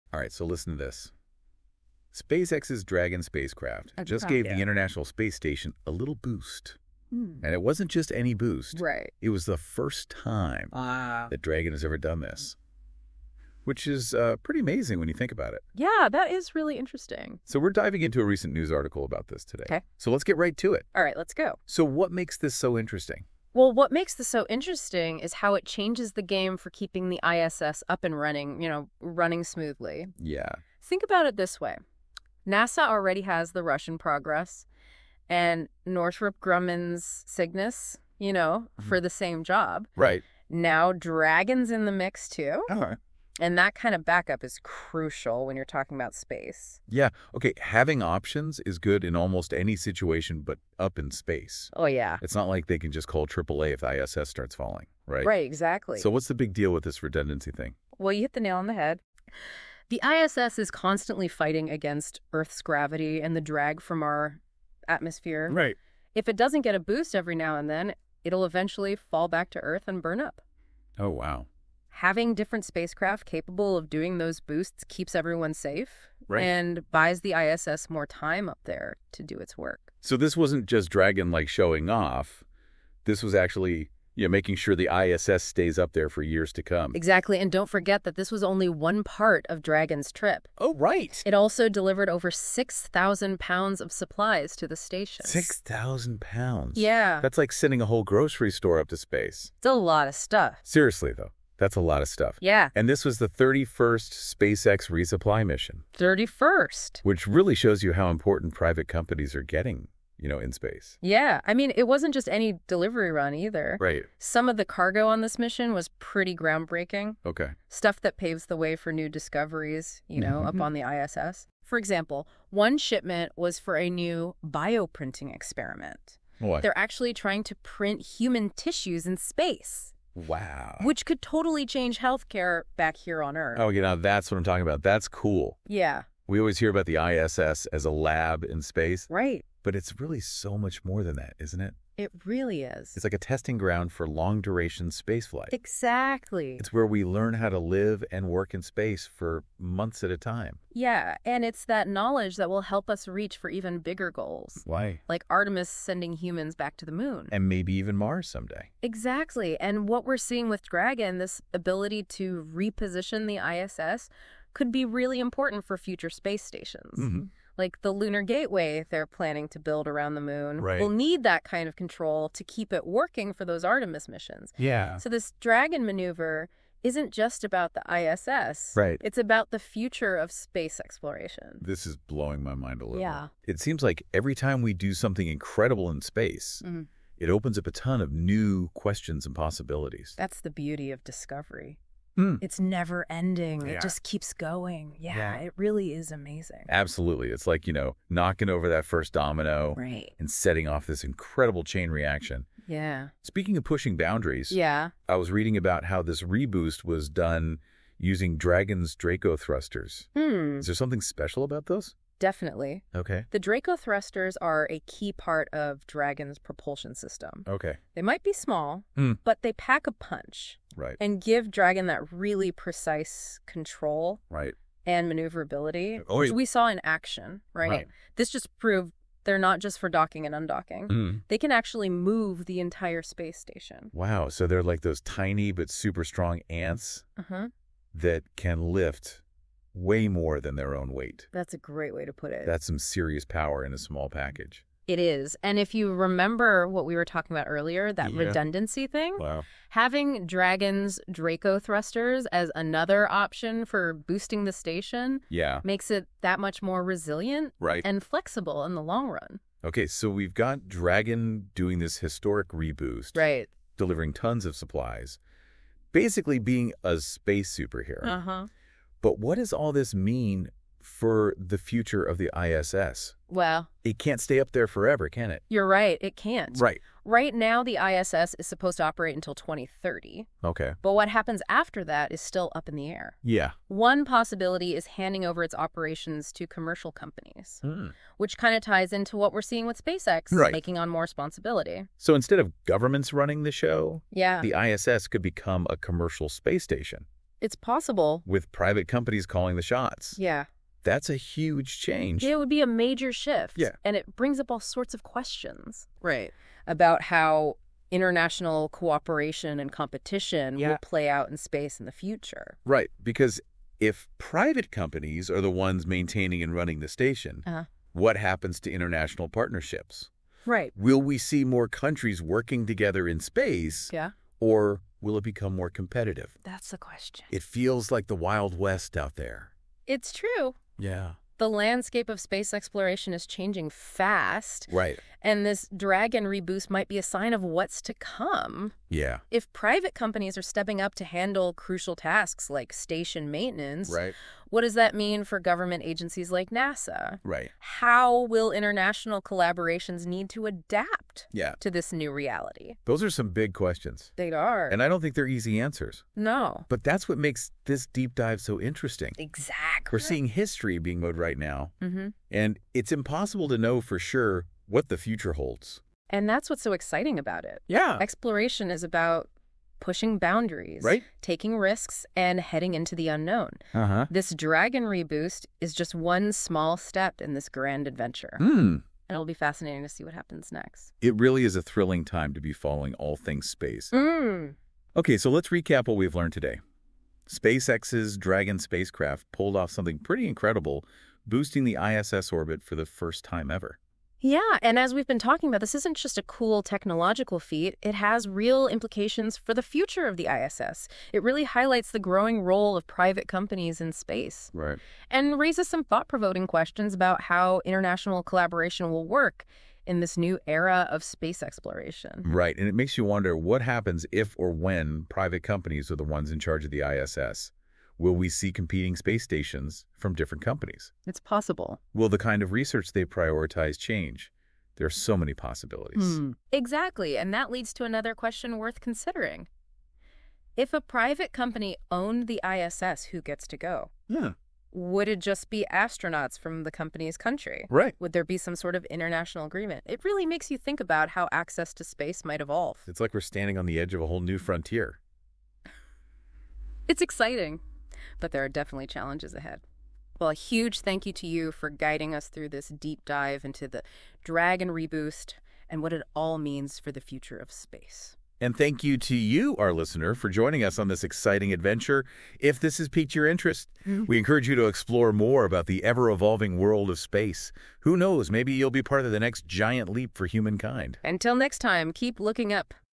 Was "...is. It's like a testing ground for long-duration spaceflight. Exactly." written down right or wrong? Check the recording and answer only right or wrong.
right.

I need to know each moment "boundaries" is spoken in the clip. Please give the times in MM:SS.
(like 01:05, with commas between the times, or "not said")
03:23, 06:10.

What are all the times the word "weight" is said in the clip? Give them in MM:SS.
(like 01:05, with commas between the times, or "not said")
04:00.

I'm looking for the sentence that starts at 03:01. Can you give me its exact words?
This is blowing my mind a little.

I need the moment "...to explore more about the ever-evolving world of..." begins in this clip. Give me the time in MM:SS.
07:44.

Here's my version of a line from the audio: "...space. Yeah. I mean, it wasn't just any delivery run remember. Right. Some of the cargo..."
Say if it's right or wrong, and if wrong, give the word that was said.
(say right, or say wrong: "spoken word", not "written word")
wrong: "either", not "remember".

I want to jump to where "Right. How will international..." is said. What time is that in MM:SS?
05:47.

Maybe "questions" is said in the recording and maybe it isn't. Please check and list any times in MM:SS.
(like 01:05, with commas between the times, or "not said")
03:08, 05:05, 05:26, 05:53, 06:46, 07:08.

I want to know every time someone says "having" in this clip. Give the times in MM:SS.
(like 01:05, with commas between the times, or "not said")
00:47, 01:11, 04:09.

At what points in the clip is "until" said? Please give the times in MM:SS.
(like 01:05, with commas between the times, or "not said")
04:39, 07:51.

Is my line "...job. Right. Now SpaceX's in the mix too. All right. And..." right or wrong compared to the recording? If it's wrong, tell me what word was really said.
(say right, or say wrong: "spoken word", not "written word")
wrong: "Dragon", not "SpaceX".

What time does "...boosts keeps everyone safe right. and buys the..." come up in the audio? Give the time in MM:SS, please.
01:14.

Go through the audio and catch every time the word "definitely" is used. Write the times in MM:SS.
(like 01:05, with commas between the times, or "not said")
03:32, 07:28.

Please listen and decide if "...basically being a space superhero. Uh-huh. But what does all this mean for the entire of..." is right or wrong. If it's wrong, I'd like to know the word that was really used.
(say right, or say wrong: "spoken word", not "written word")
wrong: "future", not "entire".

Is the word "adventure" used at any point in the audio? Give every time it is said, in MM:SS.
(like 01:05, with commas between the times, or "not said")
06:17, 07:41.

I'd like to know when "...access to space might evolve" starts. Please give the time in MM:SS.
07:21.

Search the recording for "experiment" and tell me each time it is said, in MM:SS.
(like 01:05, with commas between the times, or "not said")
02:05.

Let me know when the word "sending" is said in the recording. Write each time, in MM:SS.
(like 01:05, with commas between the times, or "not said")
01:37, 02:35.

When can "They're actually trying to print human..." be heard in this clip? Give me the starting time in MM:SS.
02:06.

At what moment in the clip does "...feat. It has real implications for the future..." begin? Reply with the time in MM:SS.
06:37.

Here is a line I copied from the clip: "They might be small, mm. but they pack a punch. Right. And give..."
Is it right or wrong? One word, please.
right.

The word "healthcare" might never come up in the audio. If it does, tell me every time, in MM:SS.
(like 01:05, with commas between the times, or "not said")
02:11.